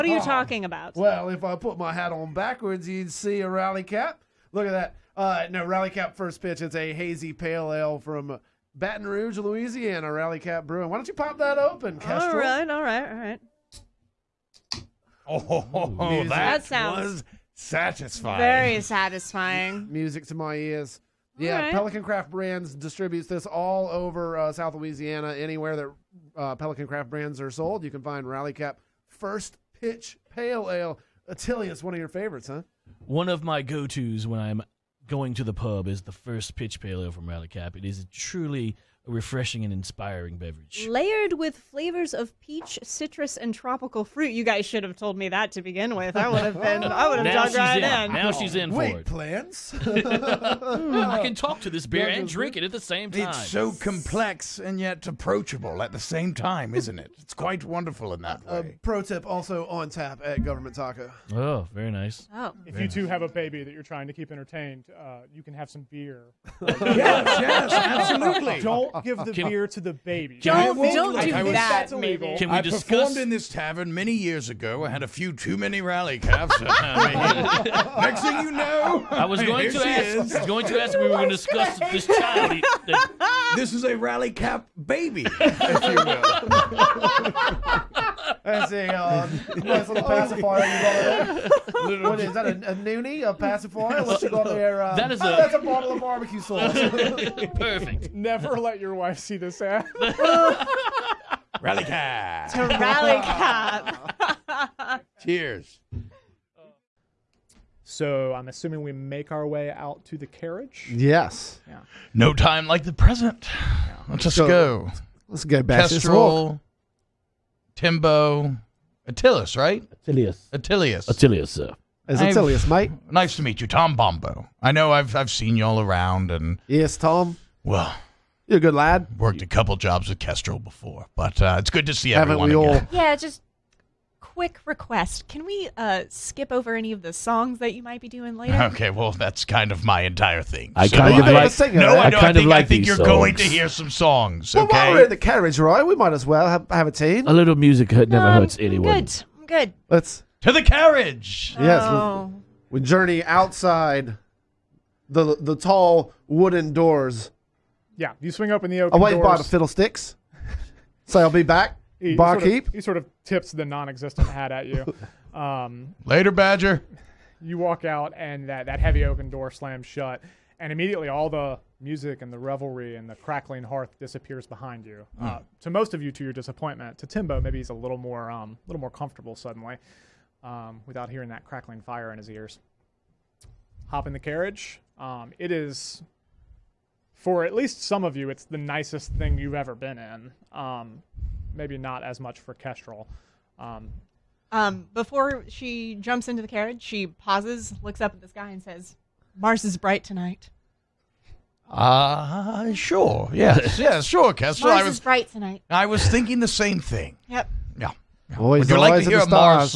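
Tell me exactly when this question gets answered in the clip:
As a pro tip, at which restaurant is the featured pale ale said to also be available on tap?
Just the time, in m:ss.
1:00.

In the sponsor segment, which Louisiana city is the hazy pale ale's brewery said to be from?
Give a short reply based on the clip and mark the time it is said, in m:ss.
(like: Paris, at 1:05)
Baton Rouge, at 0:08.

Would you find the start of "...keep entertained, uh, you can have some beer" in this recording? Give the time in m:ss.
1:04.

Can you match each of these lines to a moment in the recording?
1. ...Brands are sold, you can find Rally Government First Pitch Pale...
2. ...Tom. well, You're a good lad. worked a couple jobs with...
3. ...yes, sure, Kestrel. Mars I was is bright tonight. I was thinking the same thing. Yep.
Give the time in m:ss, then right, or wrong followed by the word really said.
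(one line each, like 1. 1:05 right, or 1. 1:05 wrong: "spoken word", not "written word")
1. 0:27 wrong: "Cap", not "Government"
2. 2:06 right
3. 3:23 right.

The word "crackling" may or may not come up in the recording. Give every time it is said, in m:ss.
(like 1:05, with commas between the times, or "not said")
2:53, 3:01.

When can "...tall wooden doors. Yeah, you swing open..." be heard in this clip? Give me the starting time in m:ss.
2:35.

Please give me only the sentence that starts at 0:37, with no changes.
It is truly refreshing and inspiring beverage.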